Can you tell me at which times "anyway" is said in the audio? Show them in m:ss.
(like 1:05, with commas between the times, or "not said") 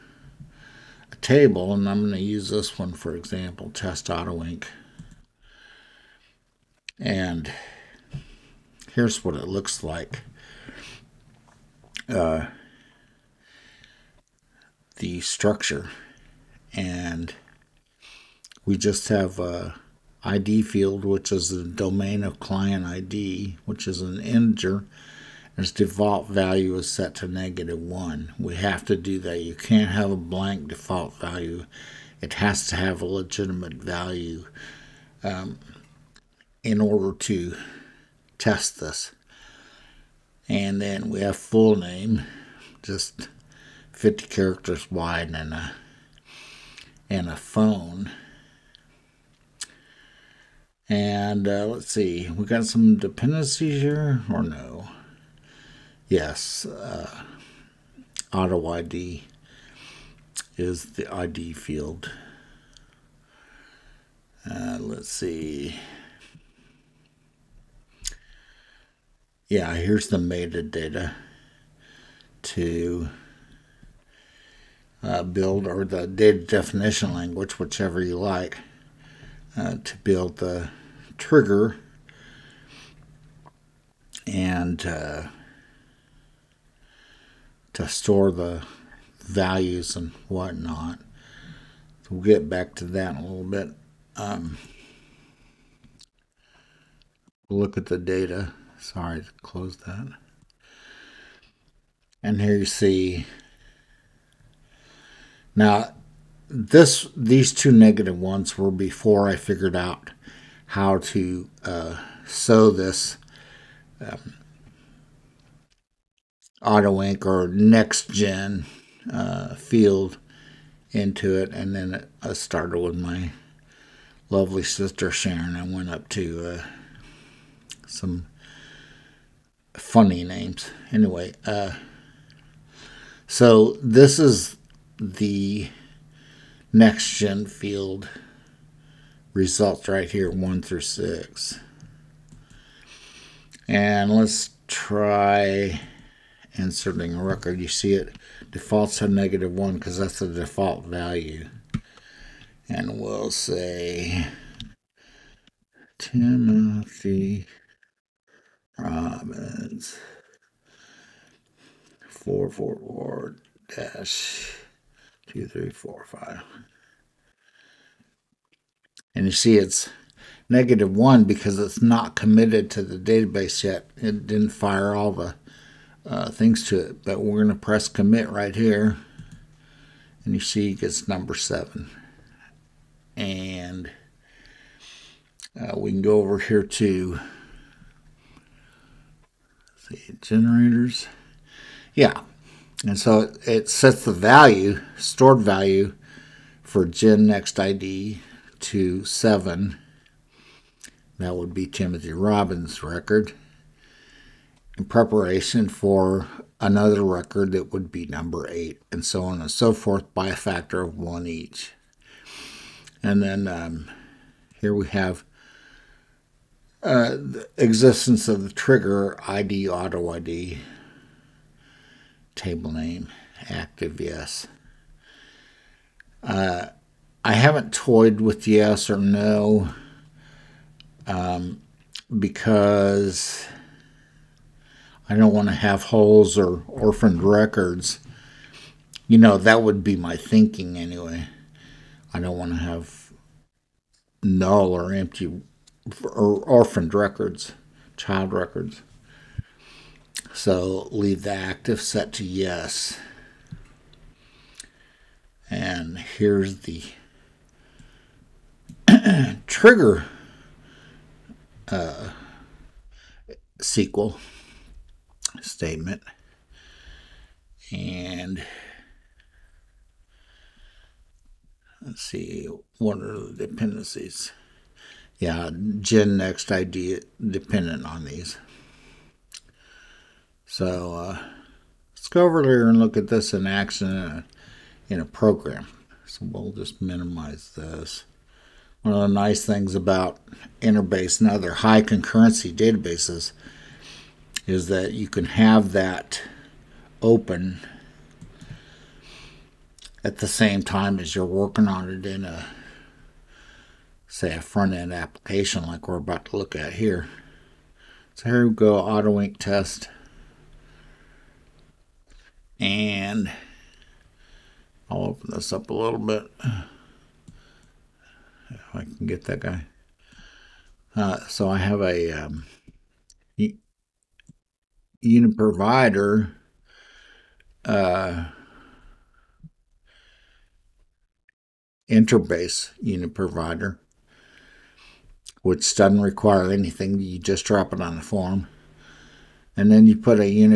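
2:10, 4:00.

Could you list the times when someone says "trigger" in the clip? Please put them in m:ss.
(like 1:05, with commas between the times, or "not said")
1:21, 3:38, 4:19.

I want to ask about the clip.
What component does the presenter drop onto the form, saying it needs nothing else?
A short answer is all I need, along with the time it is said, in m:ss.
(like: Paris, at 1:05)
InterBase UniProvider, at 5:31.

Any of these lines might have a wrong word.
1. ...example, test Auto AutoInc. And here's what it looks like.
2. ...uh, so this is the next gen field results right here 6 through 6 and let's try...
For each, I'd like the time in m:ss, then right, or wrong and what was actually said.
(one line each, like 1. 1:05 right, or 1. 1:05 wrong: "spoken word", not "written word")
1. 0:03 right
2. 2:11 wrong: "1", not "6".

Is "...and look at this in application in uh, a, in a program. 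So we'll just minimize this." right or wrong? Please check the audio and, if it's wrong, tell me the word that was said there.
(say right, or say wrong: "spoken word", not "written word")
wrong: "action", not "application".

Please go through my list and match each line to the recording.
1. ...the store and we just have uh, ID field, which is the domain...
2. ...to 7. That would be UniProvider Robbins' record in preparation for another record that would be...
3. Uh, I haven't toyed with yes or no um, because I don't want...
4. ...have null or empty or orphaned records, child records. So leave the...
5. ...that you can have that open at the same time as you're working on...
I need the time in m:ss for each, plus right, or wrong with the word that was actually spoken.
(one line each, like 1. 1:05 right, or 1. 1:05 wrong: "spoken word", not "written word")
1. 0:14 wrong: "structure", not "store"
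2. 3:18 wrong: "Timothy", not "UniProvider"
3. 3:46 right
4. 4:02 right
5. 4:54 right.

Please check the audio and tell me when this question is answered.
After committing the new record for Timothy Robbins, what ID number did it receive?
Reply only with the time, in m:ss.
3:01.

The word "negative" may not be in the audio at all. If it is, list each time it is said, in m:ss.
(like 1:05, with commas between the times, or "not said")
0:27, 1:47, 2:29, 2:50.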